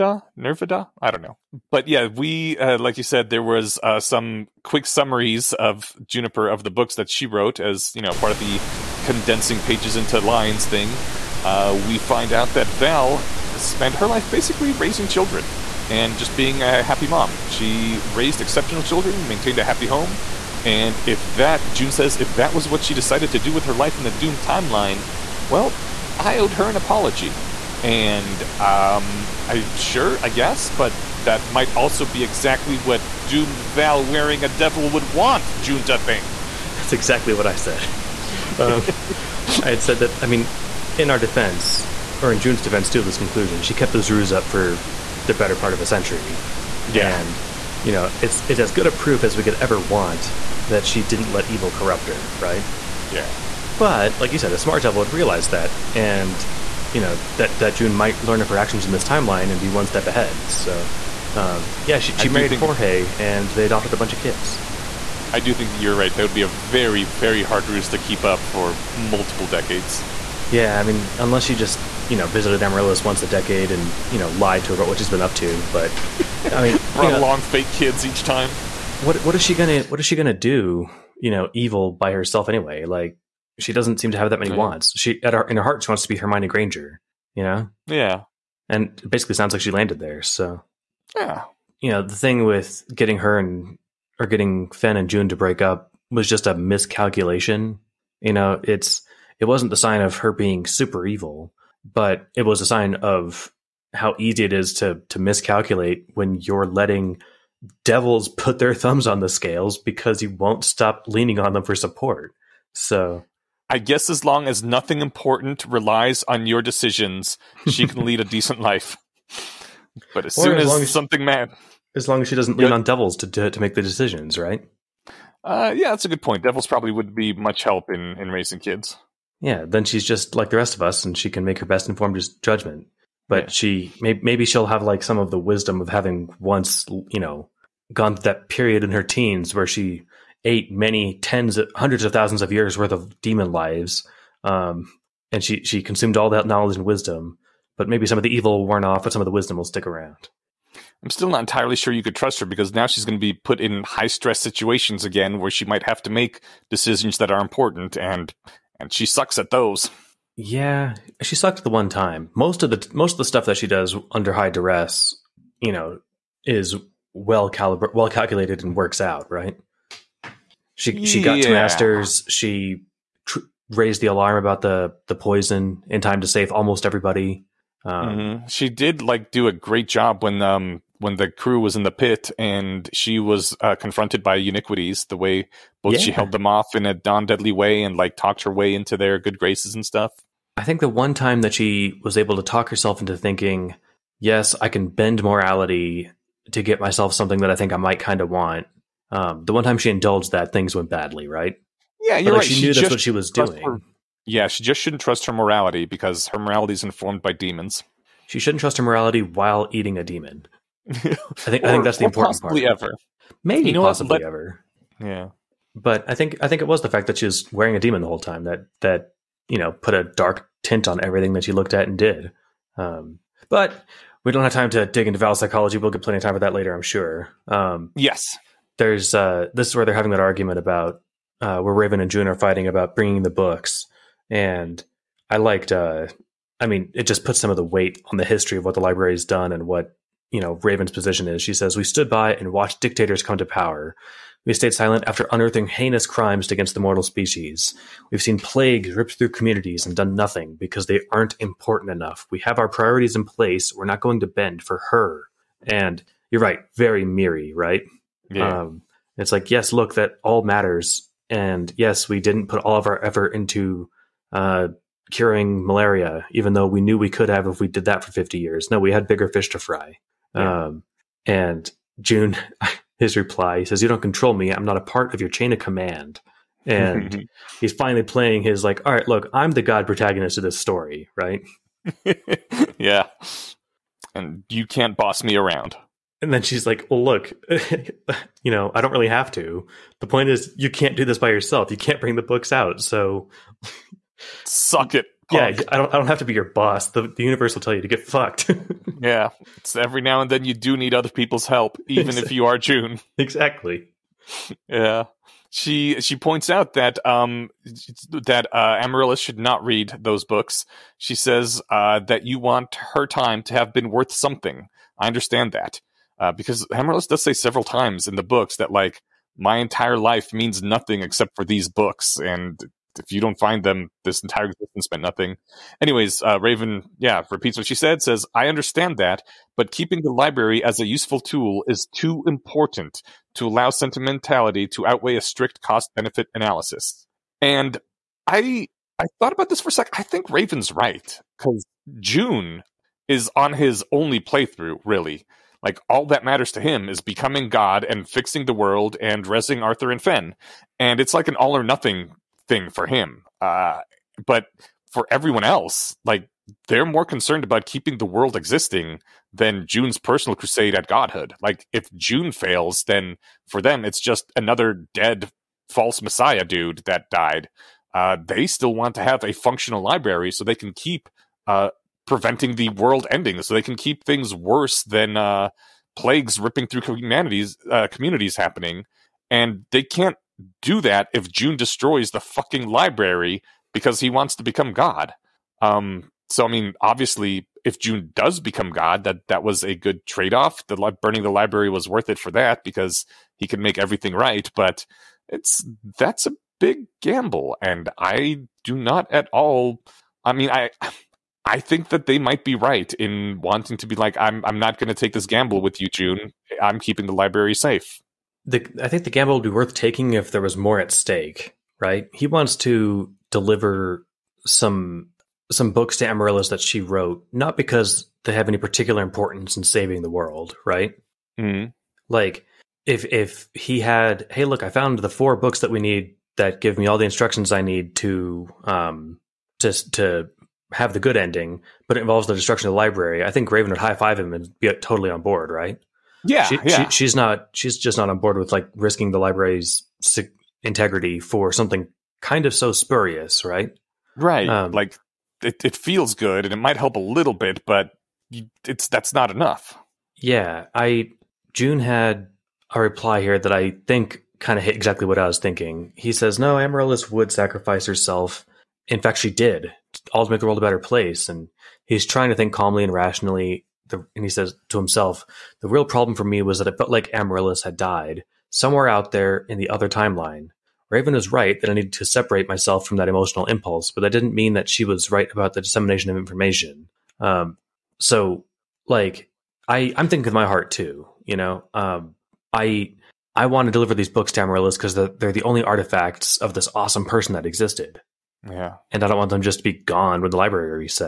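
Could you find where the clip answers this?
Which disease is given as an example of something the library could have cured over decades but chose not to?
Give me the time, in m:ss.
4:25.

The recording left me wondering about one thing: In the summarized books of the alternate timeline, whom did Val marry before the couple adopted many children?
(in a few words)
Jorge.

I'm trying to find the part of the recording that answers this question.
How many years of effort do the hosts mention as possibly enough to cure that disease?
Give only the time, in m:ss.
4:28.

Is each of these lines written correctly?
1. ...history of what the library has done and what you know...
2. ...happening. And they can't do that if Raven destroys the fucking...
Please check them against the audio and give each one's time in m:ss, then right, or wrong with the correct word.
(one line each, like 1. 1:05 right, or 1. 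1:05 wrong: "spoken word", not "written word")
1. 3:58 right
2. 6:18 wrong: "Joon", not "Raven".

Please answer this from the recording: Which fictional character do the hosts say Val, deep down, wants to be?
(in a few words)
Hermione Granger.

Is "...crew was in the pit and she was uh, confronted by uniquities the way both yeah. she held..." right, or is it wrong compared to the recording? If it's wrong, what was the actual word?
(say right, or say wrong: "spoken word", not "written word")
right.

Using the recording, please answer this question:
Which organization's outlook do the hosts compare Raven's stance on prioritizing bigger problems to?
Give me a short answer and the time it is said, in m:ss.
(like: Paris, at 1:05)
MIRI, at 4:17.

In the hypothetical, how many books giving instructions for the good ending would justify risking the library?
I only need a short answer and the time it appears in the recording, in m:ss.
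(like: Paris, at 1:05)
4, at 7:05.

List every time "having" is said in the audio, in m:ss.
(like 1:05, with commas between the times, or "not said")
2:15, 3:49.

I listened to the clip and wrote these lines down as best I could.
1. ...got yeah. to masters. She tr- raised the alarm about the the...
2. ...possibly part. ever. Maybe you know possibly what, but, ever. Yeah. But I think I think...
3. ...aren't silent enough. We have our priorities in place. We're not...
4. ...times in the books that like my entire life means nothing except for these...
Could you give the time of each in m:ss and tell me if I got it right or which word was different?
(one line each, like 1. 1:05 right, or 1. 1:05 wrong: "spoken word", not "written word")
1. 2:51 right
2. 3:32 right
3. 4:11 wrong: "important", not "silent"
4. 5:17 right.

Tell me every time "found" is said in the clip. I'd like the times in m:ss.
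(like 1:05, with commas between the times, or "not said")
7:04.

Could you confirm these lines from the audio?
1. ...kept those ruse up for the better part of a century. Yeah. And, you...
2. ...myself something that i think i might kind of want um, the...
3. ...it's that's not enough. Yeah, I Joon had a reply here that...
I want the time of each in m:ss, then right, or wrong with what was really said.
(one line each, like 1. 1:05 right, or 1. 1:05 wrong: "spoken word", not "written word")
1. 0:43 right
2. 3:16 right
3. 7:28 right.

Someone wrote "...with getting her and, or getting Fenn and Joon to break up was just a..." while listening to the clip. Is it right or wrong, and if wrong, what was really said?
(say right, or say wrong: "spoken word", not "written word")
right.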